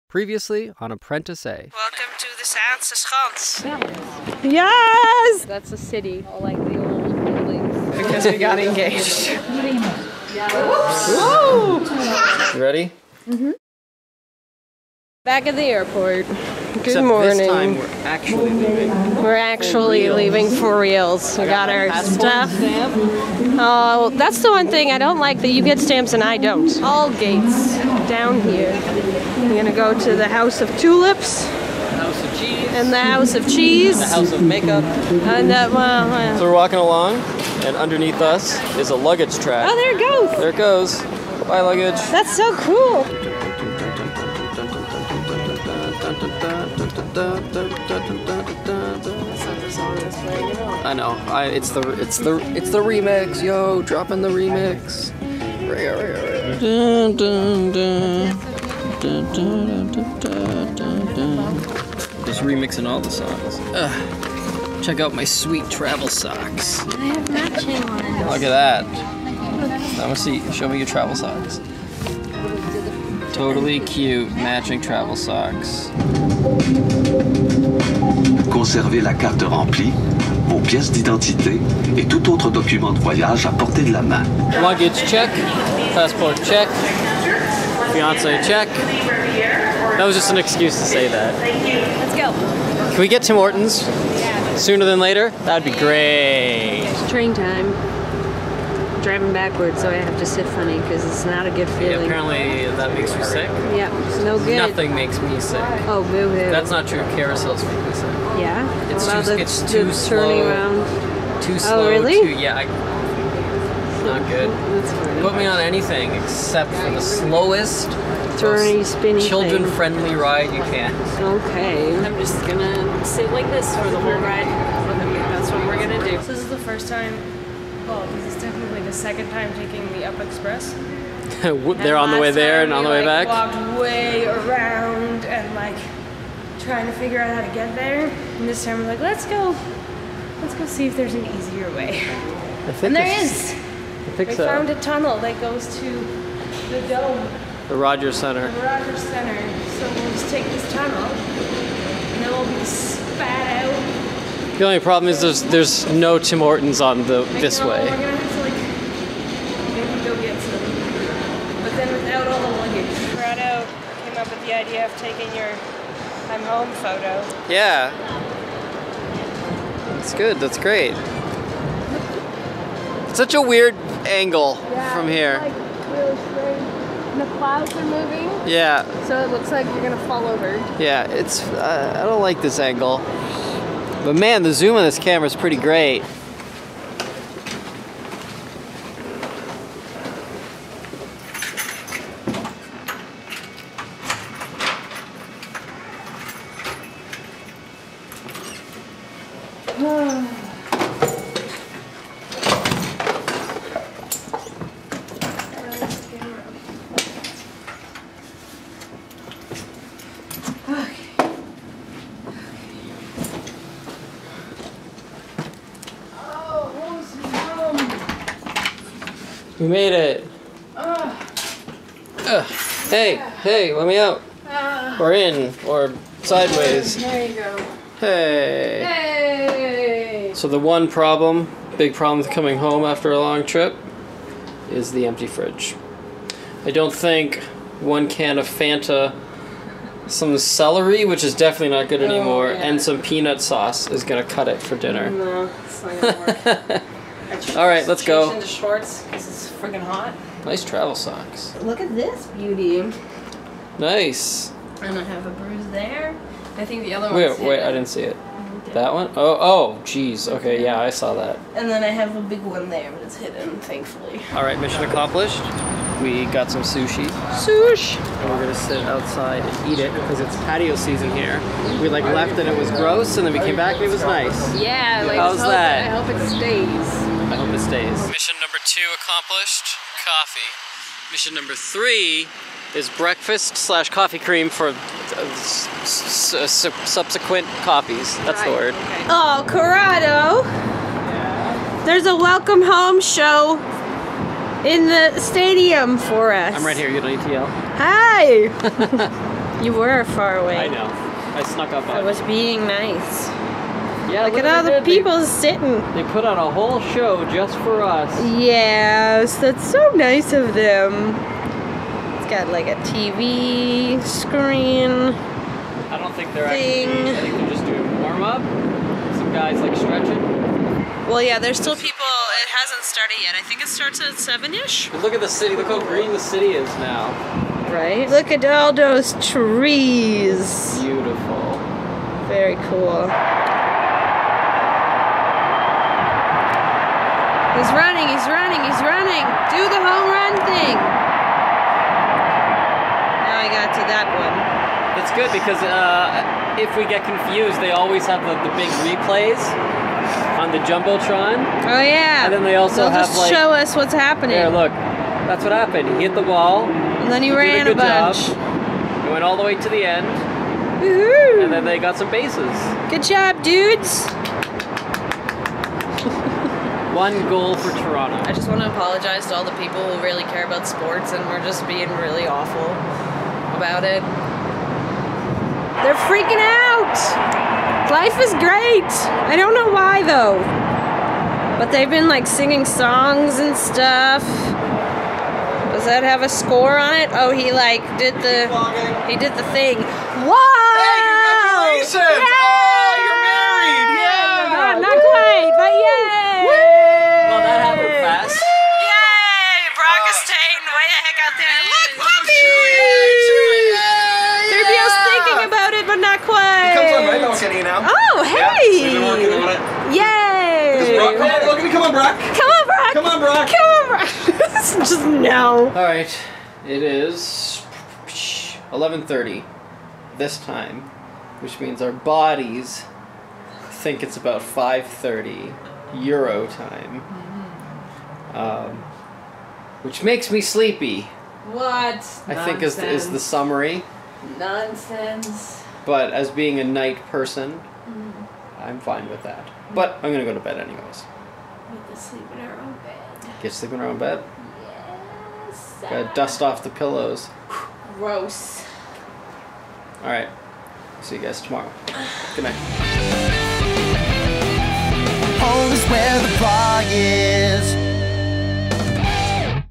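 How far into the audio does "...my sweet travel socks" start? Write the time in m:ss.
1:05.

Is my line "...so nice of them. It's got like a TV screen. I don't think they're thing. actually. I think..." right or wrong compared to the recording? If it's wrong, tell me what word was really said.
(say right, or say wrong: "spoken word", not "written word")
right.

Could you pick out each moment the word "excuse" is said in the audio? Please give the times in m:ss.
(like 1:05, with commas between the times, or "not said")
1:30.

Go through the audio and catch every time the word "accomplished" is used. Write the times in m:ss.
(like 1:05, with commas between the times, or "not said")
4:24, 4:39.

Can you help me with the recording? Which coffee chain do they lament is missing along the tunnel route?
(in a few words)
Tim Hortons.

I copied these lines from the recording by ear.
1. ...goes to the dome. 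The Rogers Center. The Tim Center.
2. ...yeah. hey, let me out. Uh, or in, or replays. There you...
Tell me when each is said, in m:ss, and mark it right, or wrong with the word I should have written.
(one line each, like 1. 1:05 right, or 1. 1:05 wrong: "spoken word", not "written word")
1. 2:25 wrong: "Rogers", not "Tim"
2. 3:43 wrong: "sideways", not "replays".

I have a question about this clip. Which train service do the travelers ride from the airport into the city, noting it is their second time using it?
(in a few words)
Up Express.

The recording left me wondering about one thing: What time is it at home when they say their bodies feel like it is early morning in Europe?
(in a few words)
11:30.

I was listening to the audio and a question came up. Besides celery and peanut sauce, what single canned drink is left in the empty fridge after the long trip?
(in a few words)
Fanta.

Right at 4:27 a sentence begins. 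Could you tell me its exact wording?
And we're gonna sit outside and eat it because it's patio season here.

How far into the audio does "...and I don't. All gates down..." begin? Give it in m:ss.
0:26.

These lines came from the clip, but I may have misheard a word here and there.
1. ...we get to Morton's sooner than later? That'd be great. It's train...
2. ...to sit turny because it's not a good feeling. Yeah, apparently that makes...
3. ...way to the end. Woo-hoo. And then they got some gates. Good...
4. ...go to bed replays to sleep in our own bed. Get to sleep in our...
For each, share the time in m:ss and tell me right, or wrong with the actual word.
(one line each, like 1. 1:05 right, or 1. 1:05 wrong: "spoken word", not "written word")
1. 1:32 right
2. 1:40 wrong: "funny", not "turny"
3. 5:59 wrong: "bases", not "gates"
4. 7:20 wrong: "anyways", not "replays".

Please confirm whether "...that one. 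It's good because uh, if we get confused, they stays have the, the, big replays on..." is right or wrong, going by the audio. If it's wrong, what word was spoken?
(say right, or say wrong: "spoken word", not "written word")
wrong: "always", not "stays".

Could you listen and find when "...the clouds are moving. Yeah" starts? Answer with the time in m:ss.
2:57.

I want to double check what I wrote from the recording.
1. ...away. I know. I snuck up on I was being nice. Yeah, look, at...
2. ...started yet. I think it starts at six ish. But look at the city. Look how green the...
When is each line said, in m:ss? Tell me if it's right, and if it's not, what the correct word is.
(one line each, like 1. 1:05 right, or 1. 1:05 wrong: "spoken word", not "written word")
1. 5:00 right
2. 5:22 wrong: "seven", not "six".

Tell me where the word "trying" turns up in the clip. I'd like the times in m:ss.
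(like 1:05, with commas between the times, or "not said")
2:16.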